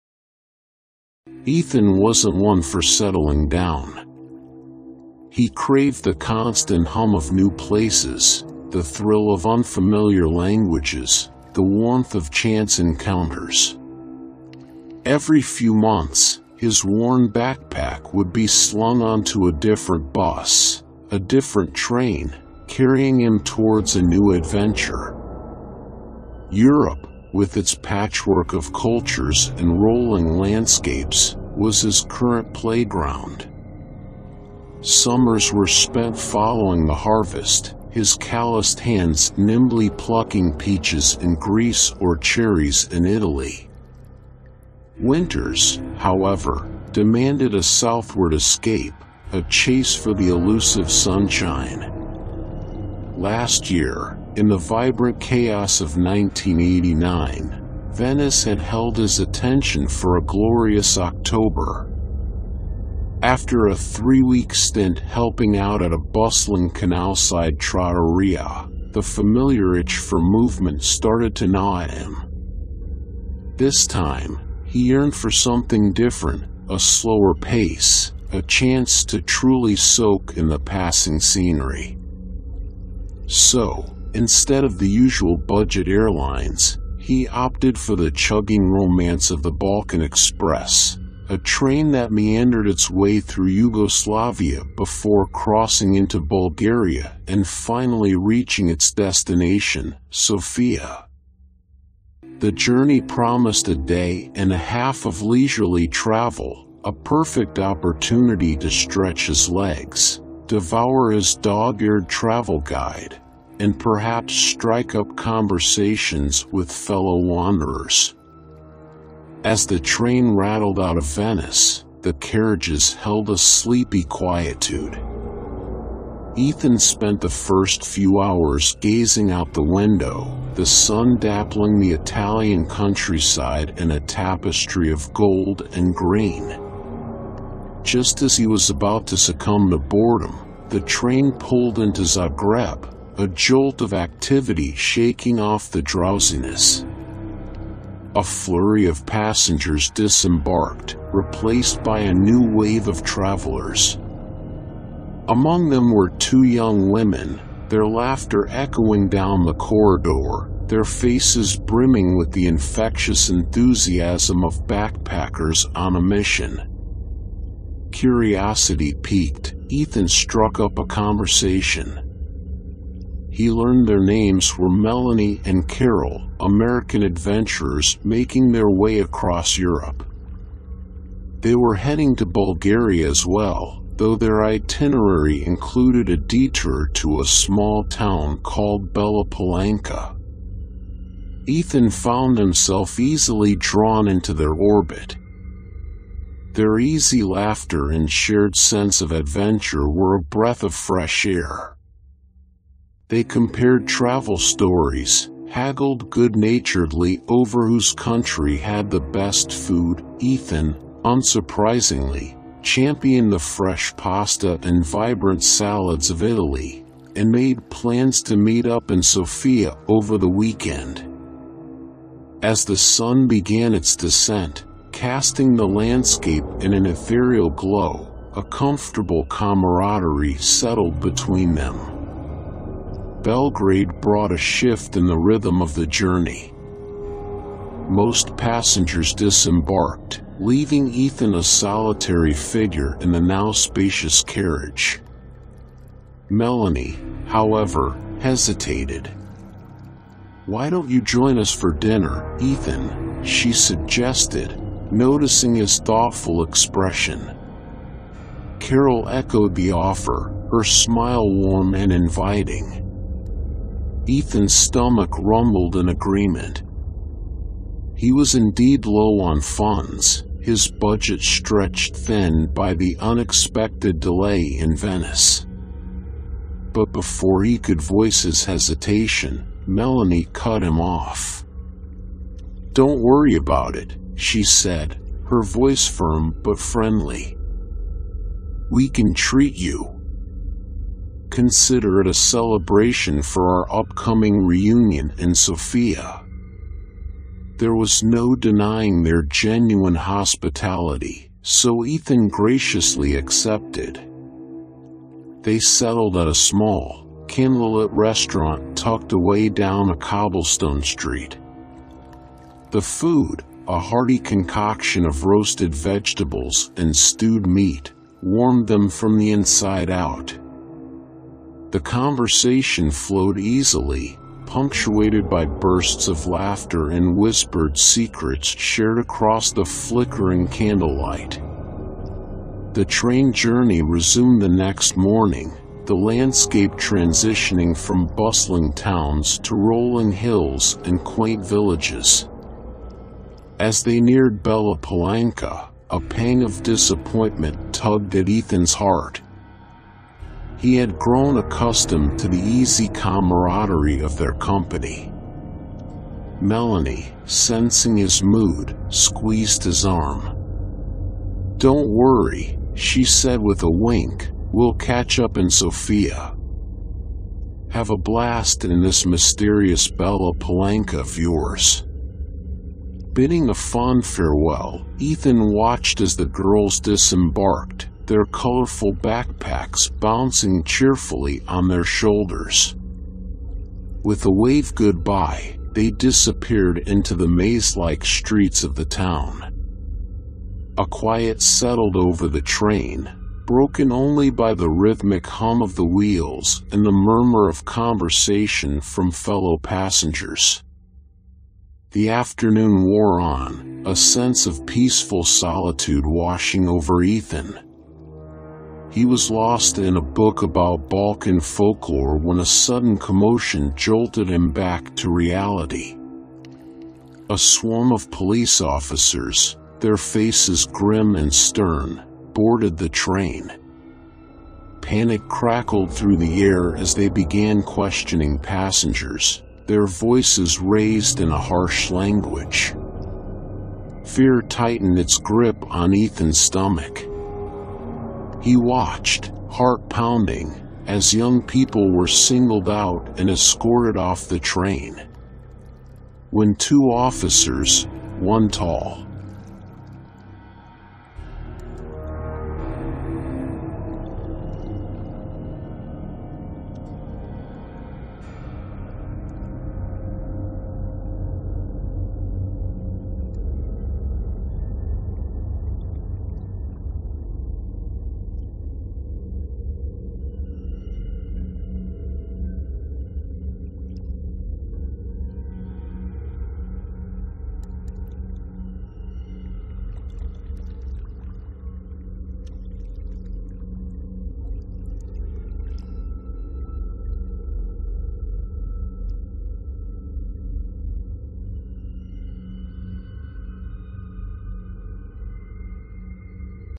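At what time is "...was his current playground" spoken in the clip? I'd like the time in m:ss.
0:31.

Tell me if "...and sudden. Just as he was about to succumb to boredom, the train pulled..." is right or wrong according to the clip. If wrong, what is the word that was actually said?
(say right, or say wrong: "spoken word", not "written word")
wrong: "green", not "sudden".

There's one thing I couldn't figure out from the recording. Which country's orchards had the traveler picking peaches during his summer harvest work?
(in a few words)
Greece.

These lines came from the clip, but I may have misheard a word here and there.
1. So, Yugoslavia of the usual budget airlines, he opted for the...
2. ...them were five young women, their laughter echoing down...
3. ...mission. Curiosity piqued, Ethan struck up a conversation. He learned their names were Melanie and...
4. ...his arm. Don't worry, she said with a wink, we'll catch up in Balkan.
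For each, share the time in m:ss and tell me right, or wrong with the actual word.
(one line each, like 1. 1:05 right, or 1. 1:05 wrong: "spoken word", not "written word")
1. 1:23 wrong: "Instead", not "Yugoslavia"
2. 2:35 wrong: "two", not "five"
3. 2:46 right
4. 5:59 wrong: "Sofia", not "Balkan".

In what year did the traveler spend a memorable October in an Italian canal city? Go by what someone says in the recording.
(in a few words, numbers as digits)
1989.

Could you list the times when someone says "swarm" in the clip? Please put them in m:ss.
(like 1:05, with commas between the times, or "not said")
6:57.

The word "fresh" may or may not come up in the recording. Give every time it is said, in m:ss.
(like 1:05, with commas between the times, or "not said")
3:20, 3:33.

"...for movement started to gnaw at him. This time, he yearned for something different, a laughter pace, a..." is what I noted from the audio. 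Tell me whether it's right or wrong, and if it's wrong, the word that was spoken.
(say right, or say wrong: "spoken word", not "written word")
wrong: "slower", not "laughter".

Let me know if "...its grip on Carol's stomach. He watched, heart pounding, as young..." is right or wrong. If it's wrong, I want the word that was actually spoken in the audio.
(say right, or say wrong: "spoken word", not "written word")
wrong: "Ethan", not "Carol".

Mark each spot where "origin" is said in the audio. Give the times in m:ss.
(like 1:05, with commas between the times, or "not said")
not said.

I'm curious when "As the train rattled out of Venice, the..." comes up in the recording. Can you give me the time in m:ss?
1:59.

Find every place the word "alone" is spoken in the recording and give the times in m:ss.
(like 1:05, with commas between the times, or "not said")
not said.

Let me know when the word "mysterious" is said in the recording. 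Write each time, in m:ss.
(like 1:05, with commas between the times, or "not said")
6:09.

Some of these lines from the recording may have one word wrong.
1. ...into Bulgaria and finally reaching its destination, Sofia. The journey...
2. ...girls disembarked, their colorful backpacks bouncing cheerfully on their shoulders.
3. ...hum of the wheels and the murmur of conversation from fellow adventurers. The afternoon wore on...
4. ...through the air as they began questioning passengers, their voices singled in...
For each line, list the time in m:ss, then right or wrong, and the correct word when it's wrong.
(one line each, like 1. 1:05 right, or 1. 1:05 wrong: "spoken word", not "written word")
1. 1:35 right
2. 6:16 right
3. 6:35 wrong: "passengers", not "adventurers"
4. 7:05 wrong: "raised", not "singled".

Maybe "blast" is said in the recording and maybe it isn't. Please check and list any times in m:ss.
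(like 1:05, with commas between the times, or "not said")
6:07.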